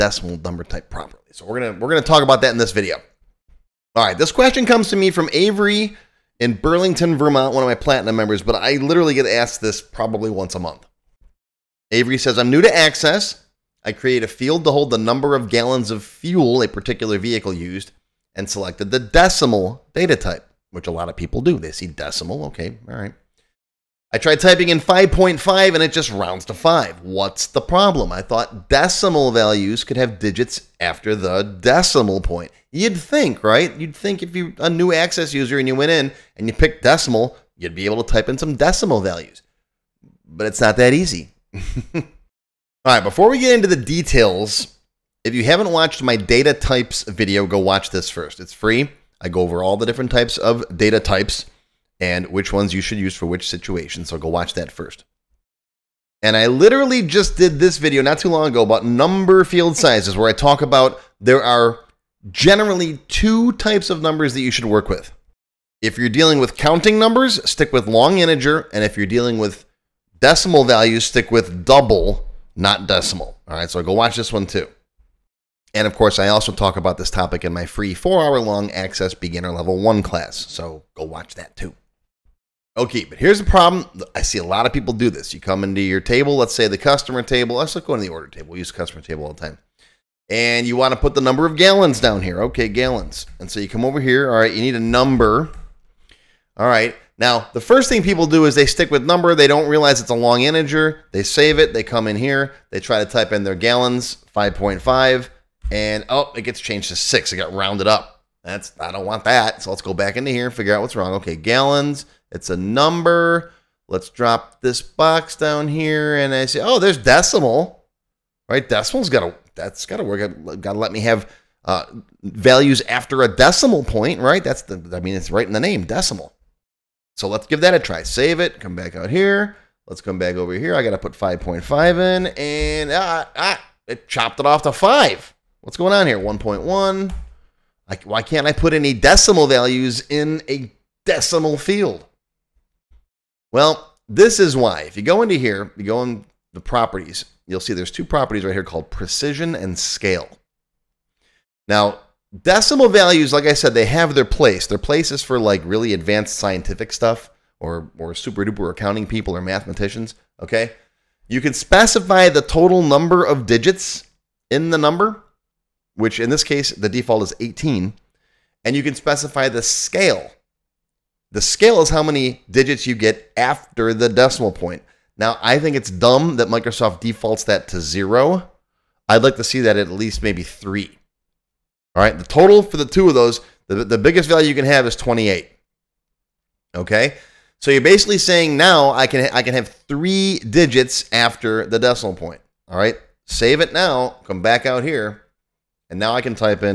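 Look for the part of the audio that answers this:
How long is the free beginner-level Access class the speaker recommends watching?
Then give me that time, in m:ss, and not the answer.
1:17.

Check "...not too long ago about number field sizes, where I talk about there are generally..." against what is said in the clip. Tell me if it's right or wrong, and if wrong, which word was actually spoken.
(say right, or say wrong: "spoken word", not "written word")
right.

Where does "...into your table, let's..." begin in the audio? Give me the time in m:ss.
1:25.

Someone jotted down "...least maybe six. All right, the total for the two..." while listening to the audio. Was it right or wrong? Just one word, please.
wrong.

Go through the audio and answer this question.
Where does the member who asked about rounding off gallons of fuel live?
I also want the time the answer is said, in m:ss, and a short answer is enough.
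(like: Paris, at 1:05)
Burlington, Vermont, at 0:06.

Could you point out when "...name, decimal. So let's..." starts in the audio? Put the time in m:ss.
2:05.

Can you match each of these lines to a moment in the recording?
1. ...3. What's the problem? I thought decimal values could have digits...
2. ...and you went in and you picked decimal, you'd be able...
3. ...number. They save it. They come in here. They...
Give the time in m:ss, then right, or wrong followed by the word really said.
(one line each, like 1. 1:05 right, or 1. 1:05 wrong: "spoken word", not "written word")
1. 0:26 wrong: "5", not "3"
2. 0:35 right
3. 1:40 wrong: "integer", not "number".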